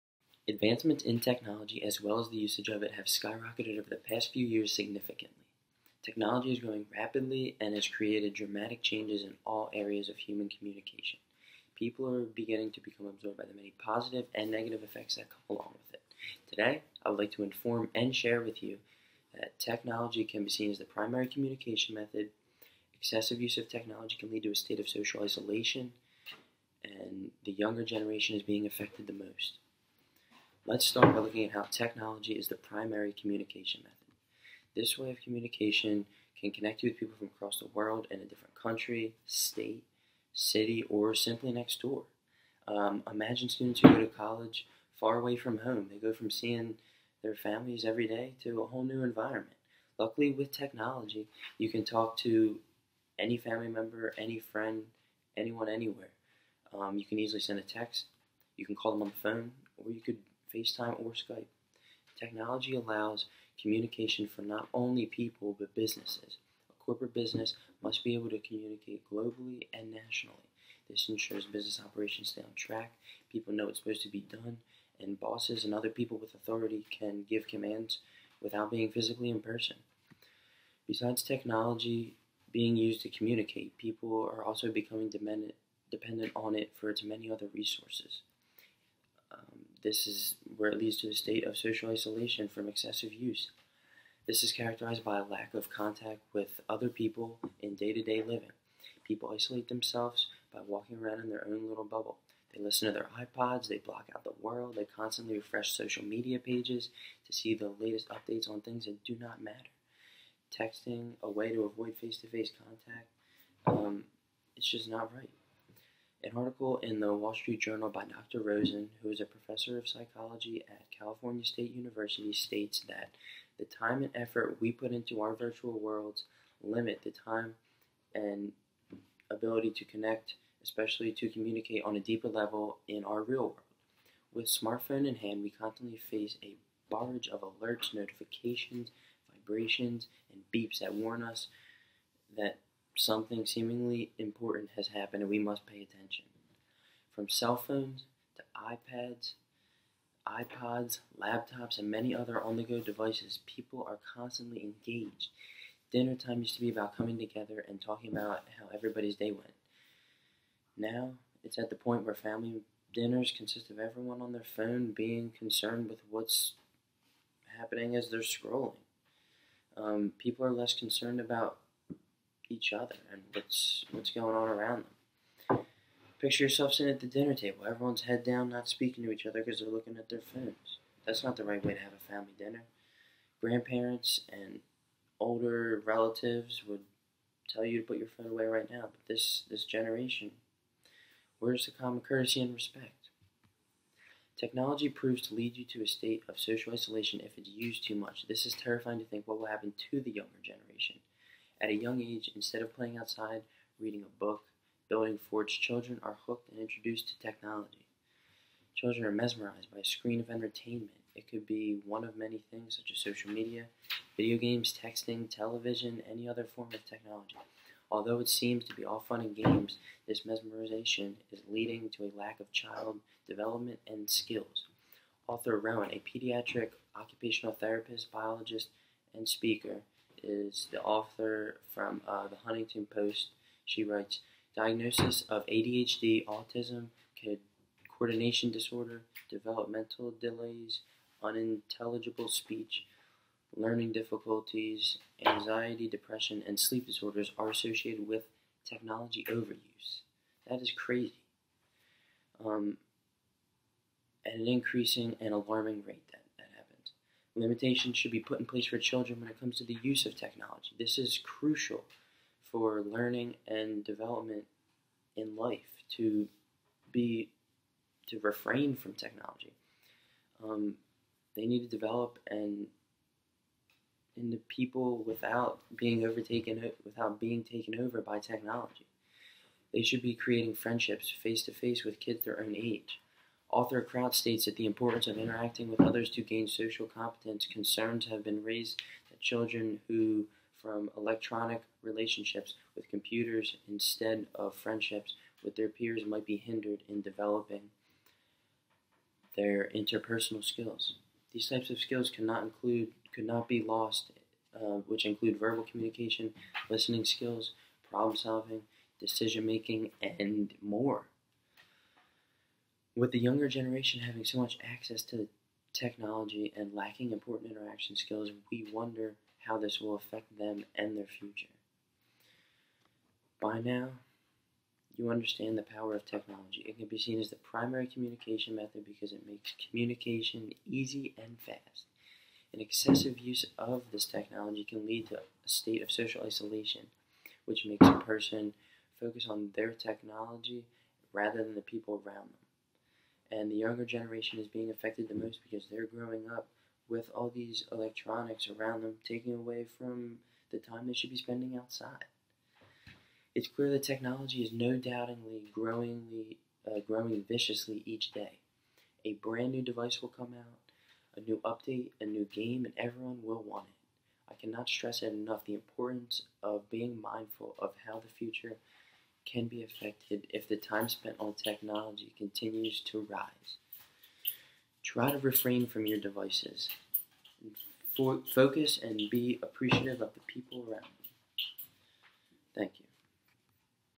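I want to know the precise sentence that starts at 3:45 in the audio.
Author Rowan, a pediatric occupational therapist, biologist, and speaker, is the author from uh, the Huffington Post.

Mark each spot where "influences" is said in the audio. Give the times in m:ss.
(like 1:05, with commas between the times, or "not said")
not said.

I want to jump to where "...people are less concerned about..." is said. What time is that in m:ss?
2:50.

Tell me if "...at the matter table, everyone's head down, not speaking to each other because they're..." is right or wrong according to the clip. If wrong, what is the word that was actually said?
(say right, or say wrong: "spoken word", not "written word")
wrong: "dinner", not "matter".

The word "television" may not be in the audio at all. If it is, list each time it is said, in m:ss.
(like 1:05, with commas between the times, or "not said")
3:35.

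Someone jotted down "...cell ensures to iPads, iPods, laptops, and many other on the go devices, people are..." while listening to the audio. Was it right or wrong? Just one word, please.
wrong.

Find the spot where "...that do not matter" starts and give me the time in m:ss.
1:48.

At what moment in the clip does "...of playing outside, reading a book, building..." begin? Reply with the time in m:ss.
3:22.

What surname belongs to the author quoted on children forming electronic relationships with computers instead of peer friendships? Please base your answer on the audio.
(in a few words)
Kraut.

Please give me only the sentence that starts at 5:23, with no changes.
By now, you understand the power of technology.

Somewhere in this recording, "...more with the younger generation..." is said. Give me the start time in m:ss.
5:10.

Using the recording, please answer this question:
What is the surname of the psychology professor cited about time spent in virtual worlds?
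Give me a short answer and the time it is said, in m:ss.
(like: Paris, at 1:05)
Rosen, at 1:58.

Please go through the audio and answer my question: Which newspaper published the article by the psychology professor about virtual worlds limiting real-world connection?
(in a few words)
Wall Street Journal.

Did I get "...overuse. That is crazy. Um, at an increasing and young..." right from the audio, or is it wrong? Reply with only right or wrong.
wrong.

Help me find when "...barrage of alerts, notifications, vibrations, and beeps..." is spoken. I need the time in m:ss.
2:16.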